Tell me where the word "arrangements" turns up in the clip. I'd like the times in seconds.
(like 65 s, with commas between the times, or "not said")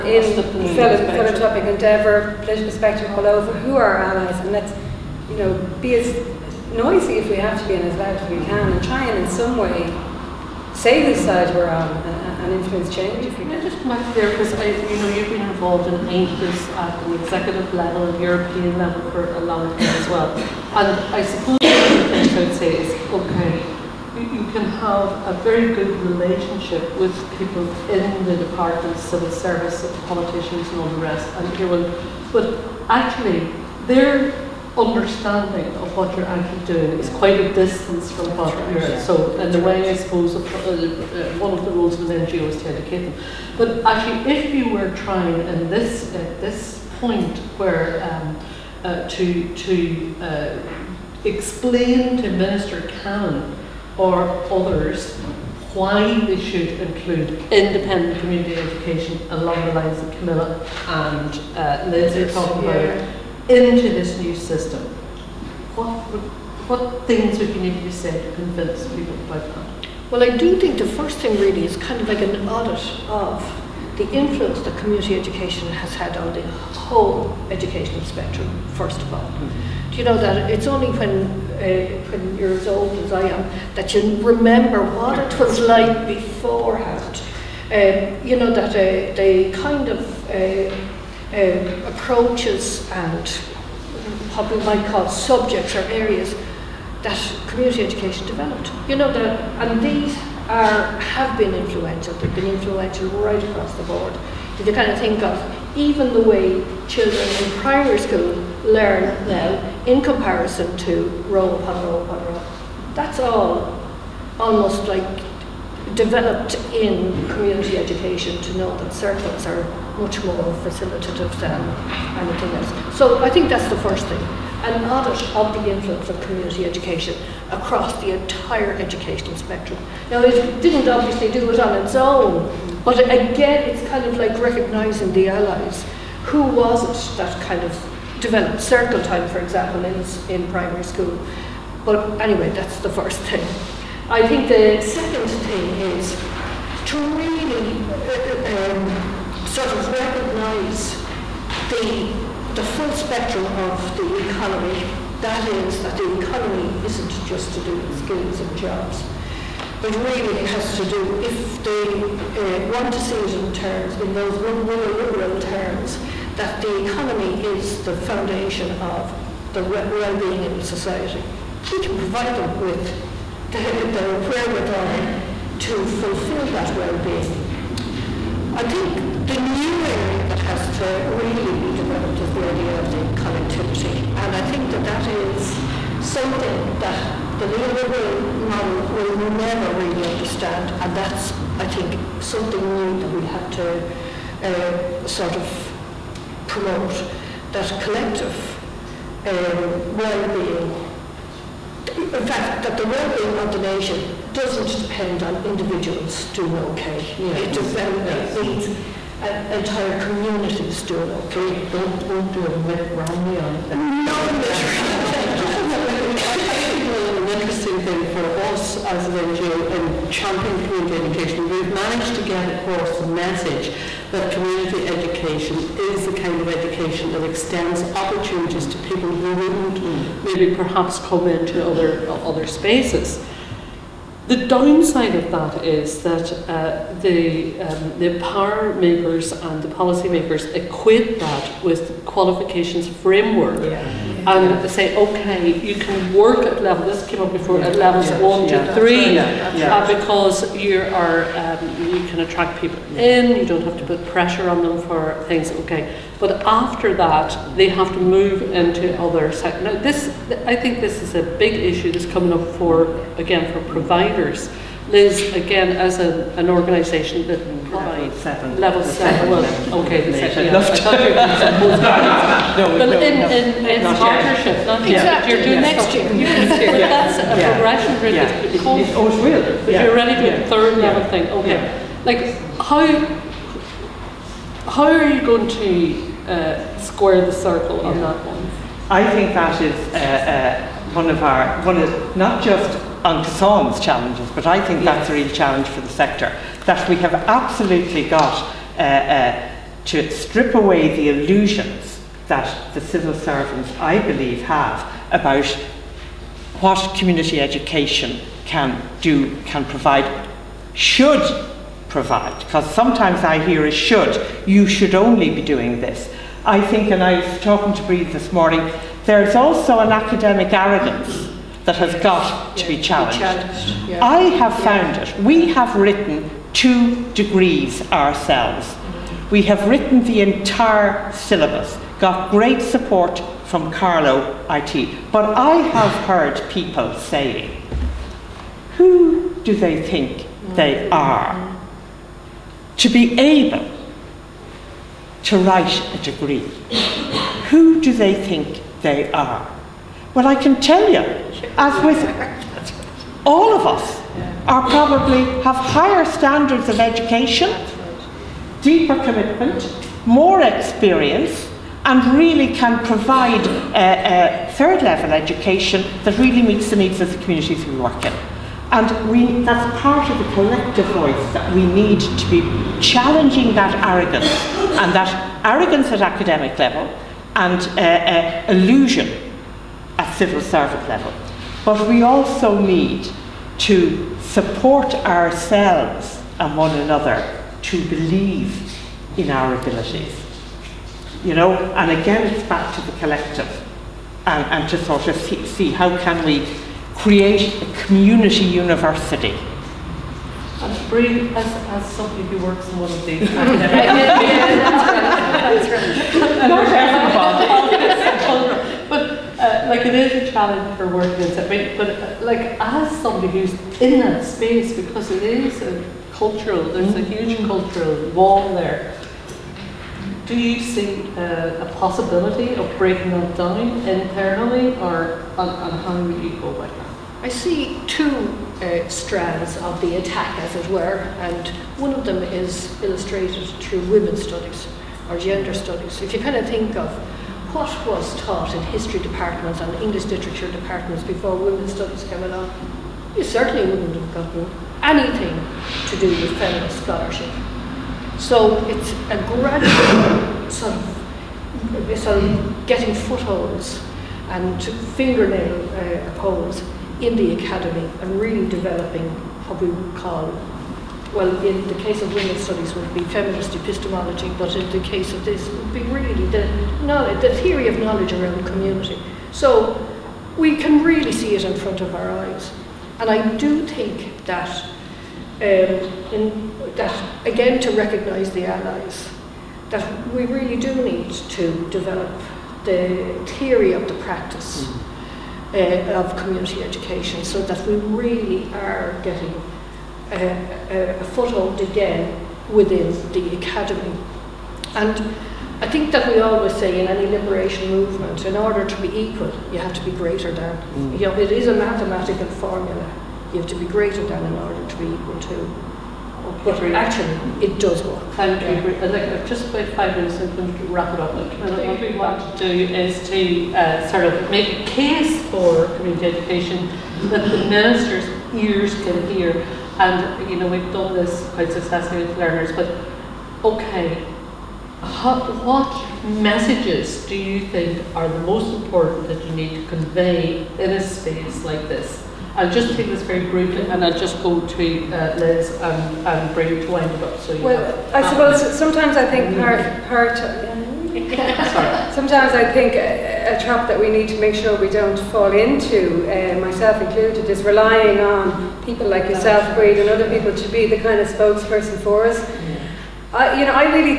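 not said.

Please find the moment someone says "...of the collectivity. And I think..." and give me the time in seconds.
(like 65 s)
182 s.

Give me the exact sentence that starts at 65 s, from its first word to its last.
What, what things would you need to be said to convince people about that?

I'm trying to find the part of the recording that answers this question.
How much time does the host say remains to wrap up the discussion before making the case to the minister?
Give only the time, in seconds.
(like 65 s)
509 s.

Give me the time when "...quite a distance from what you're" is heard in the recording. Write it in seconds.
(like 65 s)
37 s.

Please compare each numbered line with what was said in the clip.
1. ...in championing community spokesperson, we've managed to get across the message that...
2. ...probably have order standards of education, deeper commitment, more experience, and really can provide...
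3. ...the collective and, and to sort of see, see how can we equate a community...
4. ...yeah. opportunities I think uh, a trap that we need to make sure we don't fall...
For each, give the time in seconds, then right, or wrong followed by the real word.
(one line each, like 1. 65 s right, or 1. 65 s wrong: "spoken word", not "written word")
1. 219 s wrong: "education", not "spokesperson"
2. 354 s wrong: "higher", not "order"
3. 392 s wrong: "create", not "equate"
4. 540 s wrong: "sometimes", not "opportunities".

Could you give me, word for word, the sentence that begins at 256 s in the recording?
But after that, they have to move into other sectors.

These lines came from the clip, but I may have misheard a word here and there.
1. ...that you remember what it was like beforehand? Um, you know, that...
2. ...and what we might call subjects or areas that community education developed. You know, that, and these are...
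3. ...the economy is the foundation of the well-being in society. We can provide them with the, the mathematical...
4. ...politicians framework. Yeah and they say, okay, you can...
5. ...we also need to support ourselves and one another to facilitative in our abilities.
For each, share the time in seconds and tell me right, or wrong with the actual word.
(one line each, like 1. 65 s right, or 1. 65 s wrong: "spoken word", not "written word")
1. 83 s right
2. 93 s right
3. 166 s wrong: "wherewithal", not "mathematical"
4. 242 s wrong: "qualifications", not "politicians"
5. 381 s wrong: "believe", not "facilitative".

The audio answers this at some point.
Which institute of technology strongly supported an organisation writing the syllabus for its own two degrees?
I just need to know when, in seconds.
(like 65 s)
333 s.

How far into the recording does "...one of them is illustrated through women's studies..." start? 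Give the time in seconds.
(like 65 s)
431 s.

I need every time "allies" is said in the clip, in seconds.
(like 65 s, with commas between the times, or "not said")
3 s, 135 s, 478 s.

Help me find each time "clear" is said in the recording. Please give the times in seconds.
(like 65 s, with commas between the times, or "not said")
not said.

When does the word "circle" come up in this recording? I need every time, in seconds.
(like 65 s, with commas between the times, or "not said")
118 s, 138 s, 287 s.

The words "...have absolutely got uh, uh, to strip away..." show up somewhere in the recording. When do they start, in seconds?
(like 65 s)
296 s.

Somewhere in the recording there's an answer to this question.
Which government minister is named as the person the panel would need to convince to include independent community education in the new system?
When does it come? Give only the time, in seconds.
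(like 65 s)
52 s.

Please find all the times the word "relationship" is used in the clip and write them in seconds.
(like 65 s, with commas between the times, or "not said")
26 s.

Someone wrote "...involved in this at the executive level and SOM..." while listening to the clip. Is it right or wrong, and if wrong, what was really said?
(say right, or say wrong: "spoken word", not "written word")
wrong: "European", not "SOM".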